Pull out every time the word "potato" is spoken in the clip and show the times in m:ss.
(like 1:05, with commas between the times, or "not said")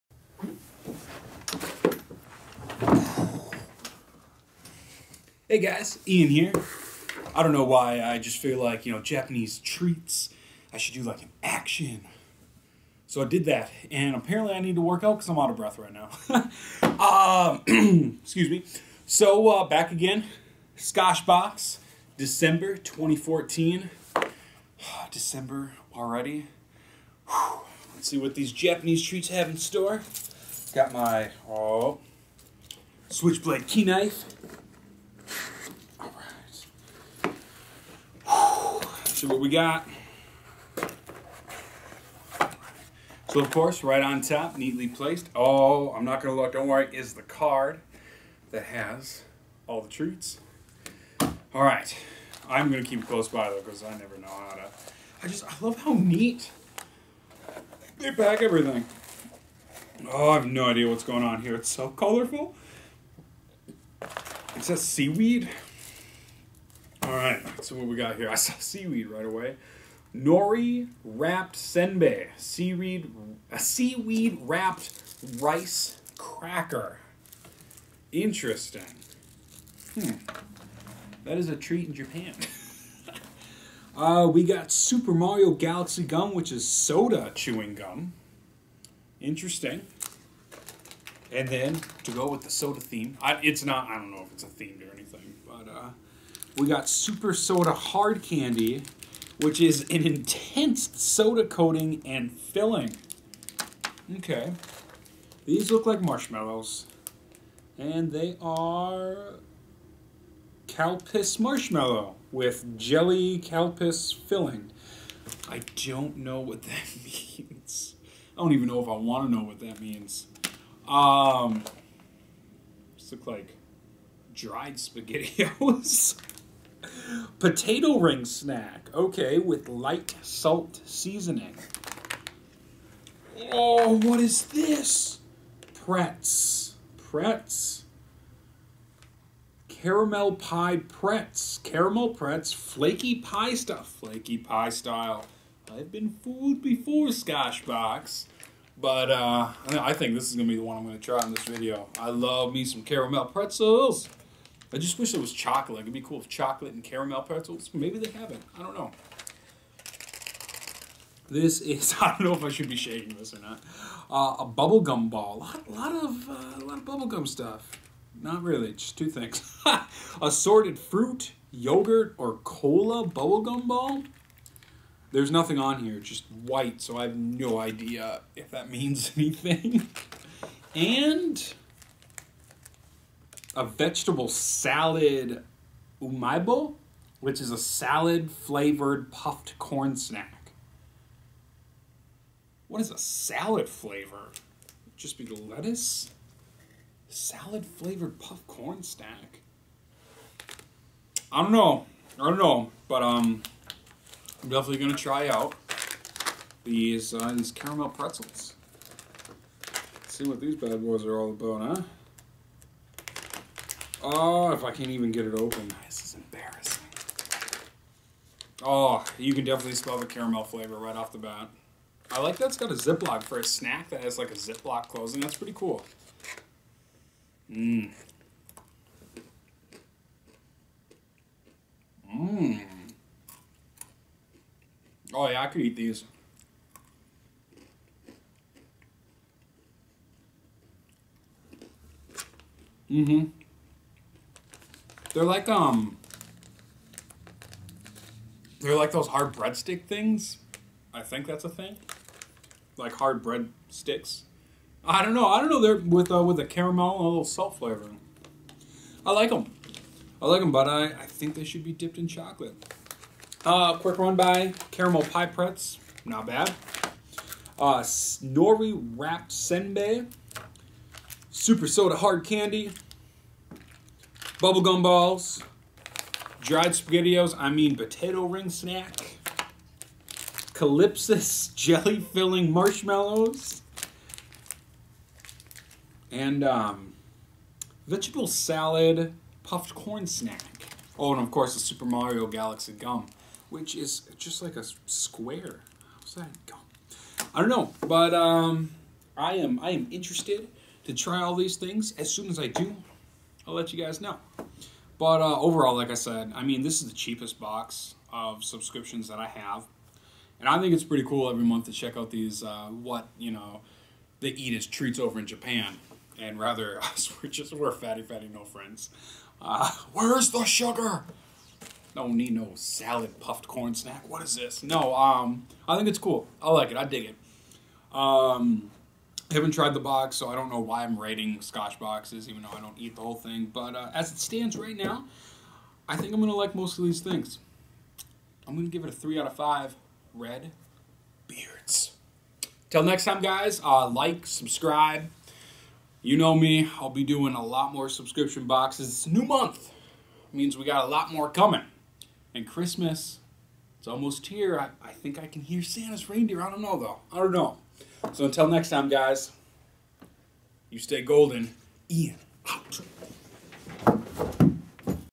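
2:07, 4:37.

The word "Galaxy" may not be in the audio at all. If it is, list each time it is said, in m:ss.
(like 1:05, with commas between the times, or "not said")
1:25, 4:52.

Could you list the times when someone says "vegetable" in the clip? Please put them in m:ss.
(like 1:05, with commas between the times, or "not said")
3:03, 4:47.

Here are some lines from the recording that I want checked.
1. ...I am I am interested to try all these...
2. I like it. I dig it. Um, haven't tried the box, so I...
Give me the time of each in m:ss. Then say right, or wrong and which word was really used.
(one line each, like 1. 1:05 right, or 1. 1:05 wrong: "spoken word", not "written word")
1. 4:59 right
2. 5:26 right.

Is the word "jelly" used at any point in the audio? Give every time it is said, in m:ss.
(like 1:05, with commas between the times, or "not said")
1:52, 4:41.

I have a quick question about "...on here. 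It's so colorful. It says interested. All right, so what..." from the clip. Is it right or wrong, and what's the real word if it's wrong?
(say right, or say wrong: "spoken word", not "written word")
wrong: "seaweed", not "interested".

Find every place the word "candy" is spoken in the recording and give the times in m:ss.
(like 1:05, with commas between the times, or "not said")
1:38, 4:32.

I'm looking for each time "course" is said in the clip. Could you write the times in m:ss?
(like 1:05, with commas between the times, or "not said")
0:43, 4:51.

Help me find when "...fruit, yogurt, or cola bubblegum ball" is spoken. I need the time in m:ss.
2:50.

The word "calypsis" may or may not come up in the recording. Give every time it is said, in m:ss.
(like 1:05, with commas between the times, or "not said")
4:40.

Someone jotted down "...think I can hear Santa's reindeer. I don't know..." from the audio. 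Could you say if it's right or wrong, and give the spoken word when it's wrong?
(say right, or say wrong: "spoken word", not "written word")
right.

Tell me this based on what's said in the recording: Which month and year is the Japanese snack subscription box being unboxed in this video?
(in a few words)
December 2014.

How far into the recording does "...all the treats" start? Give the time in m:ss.
0:49.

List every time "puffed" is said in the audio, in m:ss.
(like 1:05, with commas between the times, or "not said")
3:09, 3:18, 4:49, 5:23.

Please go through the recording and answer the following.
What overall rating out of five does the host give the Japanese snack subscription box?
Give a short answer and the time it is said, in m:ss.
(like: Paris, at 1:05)
3 out of 5, at 5:38.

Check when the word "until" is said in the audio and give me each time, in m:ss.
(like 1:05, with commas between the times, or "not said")
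5:58.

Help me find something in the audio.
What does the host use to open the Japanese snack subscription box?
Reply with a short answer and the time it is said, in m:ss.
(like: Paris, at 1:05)
switchblade key knife, at 0:33.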